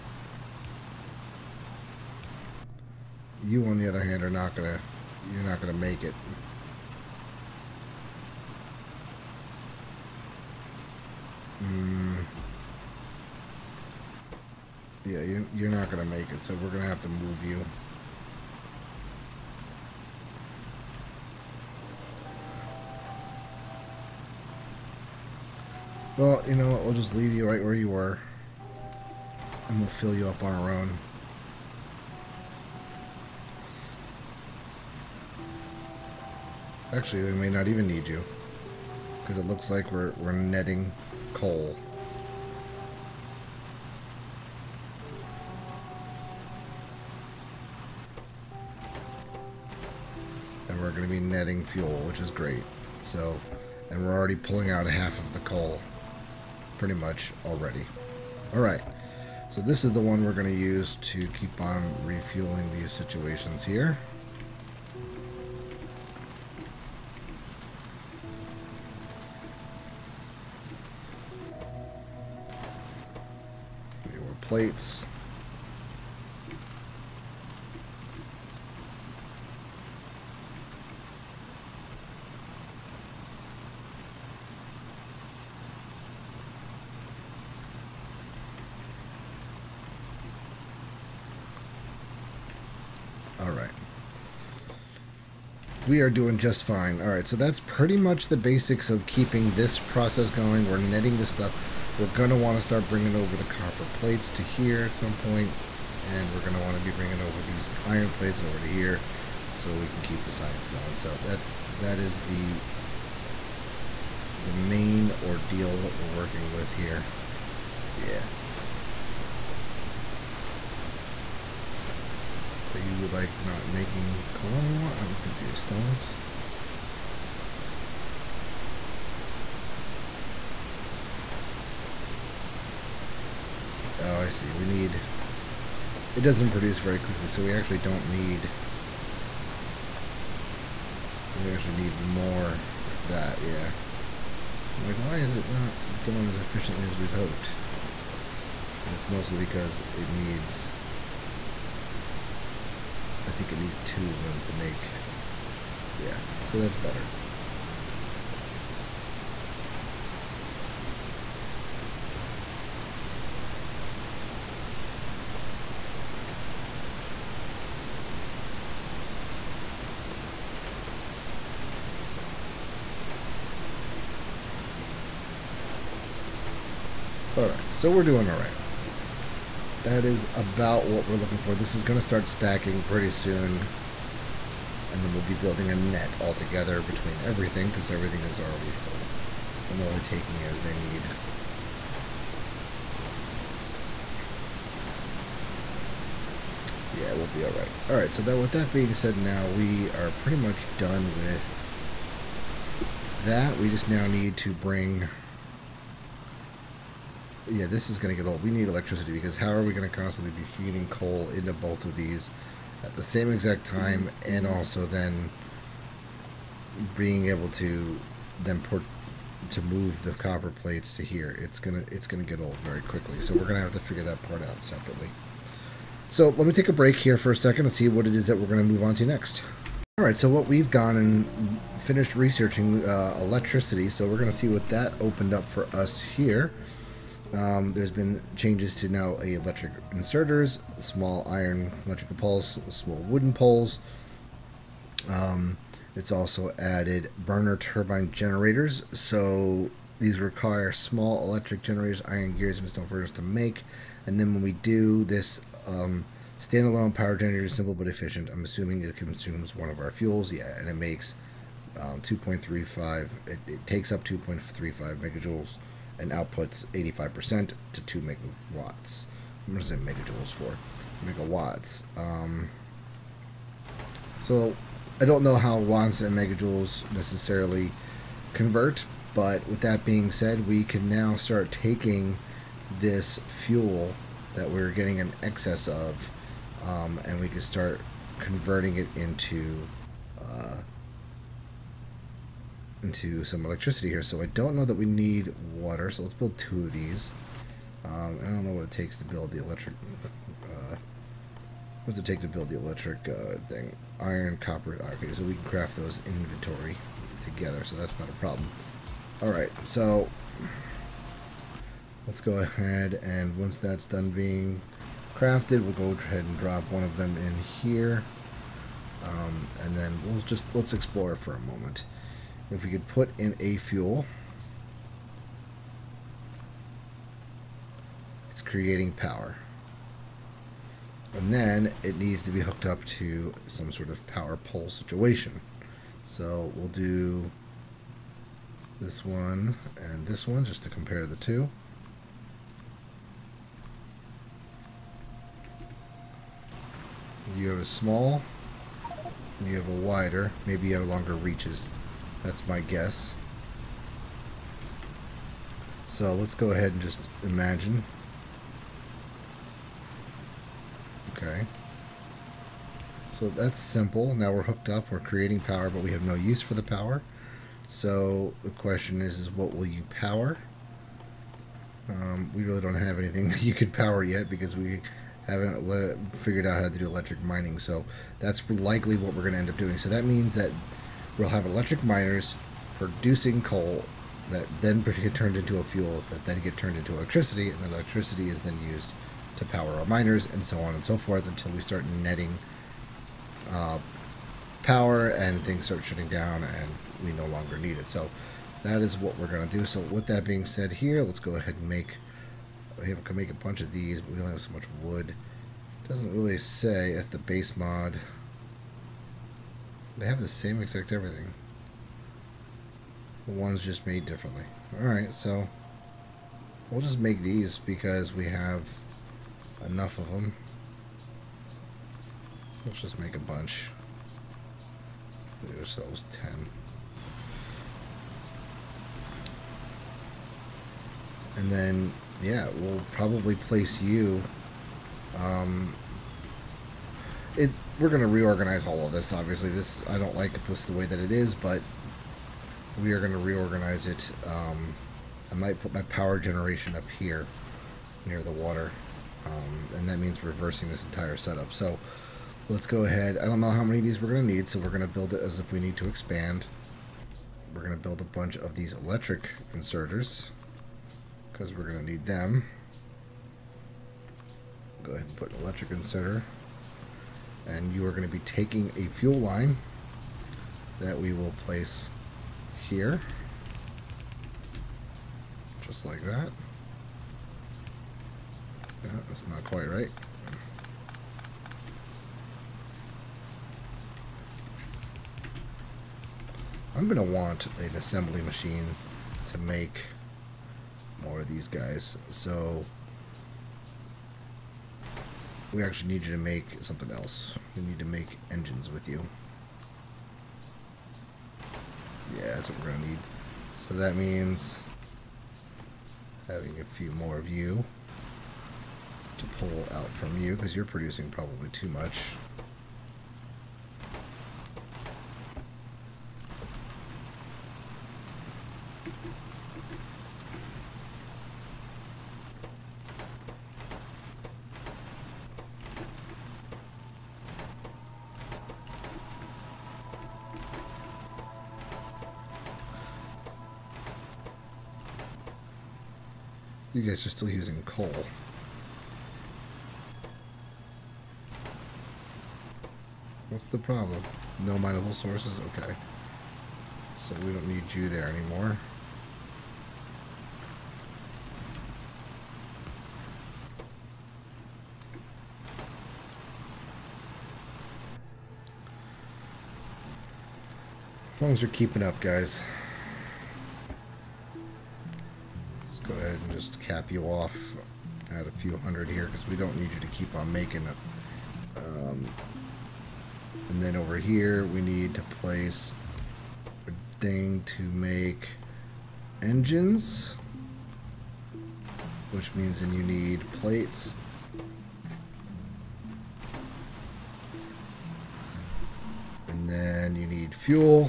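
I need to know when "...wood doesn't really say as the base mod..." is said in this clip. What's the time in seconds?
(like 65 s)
404 s.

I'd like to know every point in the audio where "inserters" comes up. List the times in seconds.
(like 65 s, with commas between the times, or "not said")
239 s, 459 s, 465 s.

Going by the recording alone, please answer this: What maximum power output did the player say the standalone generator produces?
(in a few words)
2 megawatts.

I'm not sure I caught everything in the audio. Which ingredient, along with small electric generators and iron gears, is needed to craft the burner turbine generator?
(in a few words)
stone furnace.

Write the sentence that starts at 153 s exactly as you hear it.
I think it needs two of them to make.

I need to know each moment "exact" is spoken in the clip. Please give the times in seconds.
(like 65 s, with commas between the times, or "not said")
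213 s, 410 s.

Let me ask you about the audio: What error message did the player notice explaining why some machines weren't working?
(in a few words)
No mineable sources.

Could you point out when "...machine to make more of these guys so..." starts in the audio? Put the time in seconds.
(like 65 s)
488 s.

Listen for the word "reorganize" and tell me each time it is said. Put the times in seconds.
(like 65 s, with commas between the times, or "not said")
438 s, 443 s.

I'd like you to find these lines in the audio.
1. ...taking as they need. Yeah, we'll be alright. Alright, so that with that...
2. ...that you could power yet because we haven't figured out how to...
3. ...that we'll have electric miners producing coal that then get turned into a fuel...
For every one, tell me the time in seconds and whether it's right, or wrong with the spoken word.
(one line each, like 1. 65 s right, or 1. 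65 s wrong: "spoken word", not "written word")
1. 189 s right
2. 373 s right
3. 380 s right.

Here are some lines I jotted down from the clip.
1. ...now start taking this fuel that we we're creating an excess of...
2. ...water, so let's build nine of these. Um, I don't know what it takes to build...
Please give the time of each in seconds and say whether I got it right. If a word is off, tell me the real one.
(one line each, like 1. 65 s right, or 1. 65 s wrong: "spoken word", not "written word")
1. 280 s wrong: "getting", not "creating"
2. 295 s wrong: "two", not "nine".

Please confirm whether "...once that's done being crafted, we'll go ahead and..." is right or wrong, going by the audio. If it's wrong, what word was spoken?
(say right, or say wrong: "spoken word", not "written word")
right.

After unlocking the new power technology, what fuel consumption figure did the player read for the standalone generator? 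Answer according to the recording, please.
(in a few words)
2.35 megajoules.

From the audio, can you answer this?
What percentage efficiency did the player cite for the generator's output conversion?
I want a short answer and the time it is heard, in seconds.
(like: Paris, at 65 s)
85%, at 266 s.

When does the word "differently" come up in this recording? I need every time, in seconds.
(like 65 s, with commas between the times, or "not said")
414 s.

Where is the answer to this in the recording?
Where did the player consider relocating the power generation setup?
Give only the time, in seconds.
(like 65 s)
448 s.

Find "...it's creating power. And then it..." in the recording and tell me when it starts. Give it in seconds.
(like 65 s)
328 s.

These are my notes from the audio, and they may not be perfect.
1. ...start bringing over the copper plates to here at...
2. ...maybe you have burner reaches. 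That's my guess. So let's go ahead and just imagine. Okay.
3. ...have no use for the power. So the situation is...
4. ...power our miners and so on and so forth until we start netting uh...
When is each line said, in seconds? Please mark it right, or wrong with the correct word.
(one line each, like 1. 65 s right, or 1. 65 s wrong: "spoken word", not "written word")
1. 102 s right
2. 350 s wrong: "longer", not "burner"
3. 365 s wrong: "question", not "situation"
4. 389 s right.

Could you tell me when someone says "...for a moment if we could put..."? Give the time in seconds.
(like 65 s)
321 s.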